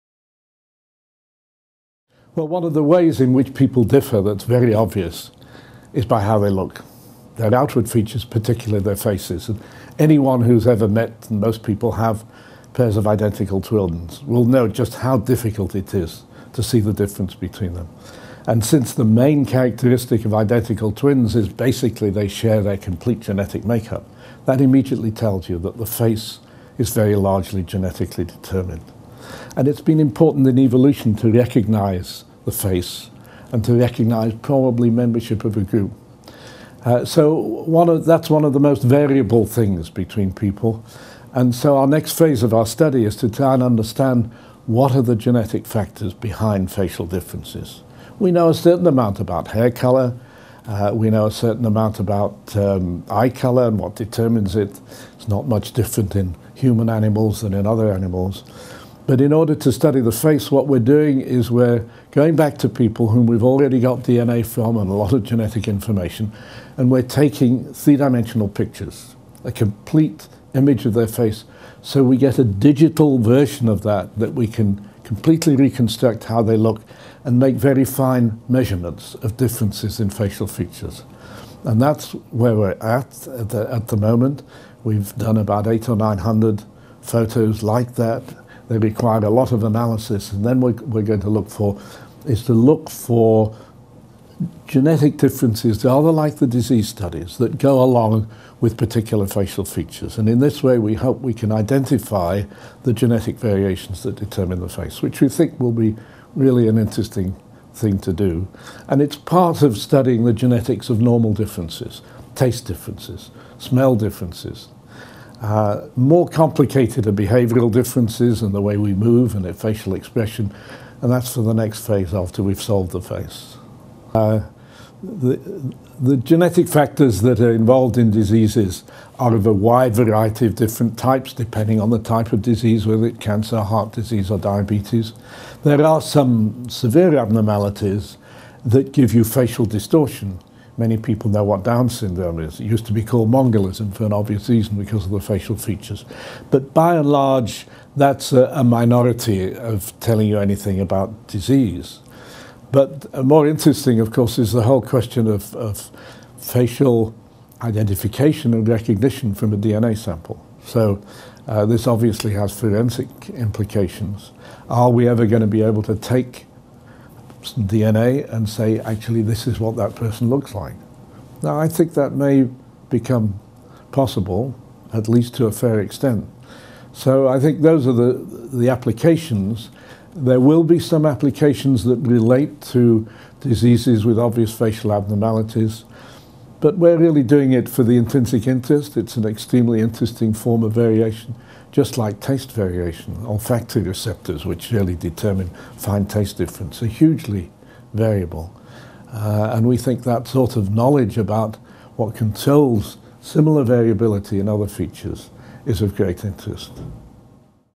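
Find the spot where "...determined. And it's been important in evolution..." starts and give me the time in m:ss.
0:28.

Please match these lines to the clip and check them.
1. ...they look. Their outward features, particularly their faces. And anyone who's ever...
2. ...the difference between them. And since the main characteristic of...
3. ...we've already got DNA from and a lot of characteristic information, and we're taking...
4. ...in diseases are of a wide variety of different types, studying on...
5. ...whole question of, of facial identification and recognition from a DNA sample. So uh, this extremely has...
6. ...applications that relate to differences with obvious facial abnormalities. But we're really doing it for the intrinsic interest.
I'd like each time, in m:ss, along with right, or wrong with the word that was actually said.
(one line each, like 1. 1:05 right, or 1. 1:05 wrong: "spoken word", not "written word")
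1. 0:06 right
2. 0:16 right
3. 1:03 wrong: "genetic", not "characteristic"
4. 2:07 wrong: "depending", not "studying"
5. 2:34 wrong: "obviously", not "extremely"
6. 3:01 wrong: "diseases", not "differences".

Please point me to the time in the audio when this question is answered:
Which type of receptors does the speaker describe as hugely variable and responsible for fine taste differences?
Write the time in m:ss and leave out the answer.
3:13.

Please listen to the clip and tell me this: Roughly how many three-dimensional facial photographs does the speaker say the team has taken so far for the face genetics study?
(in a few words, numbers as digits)
800 or 900.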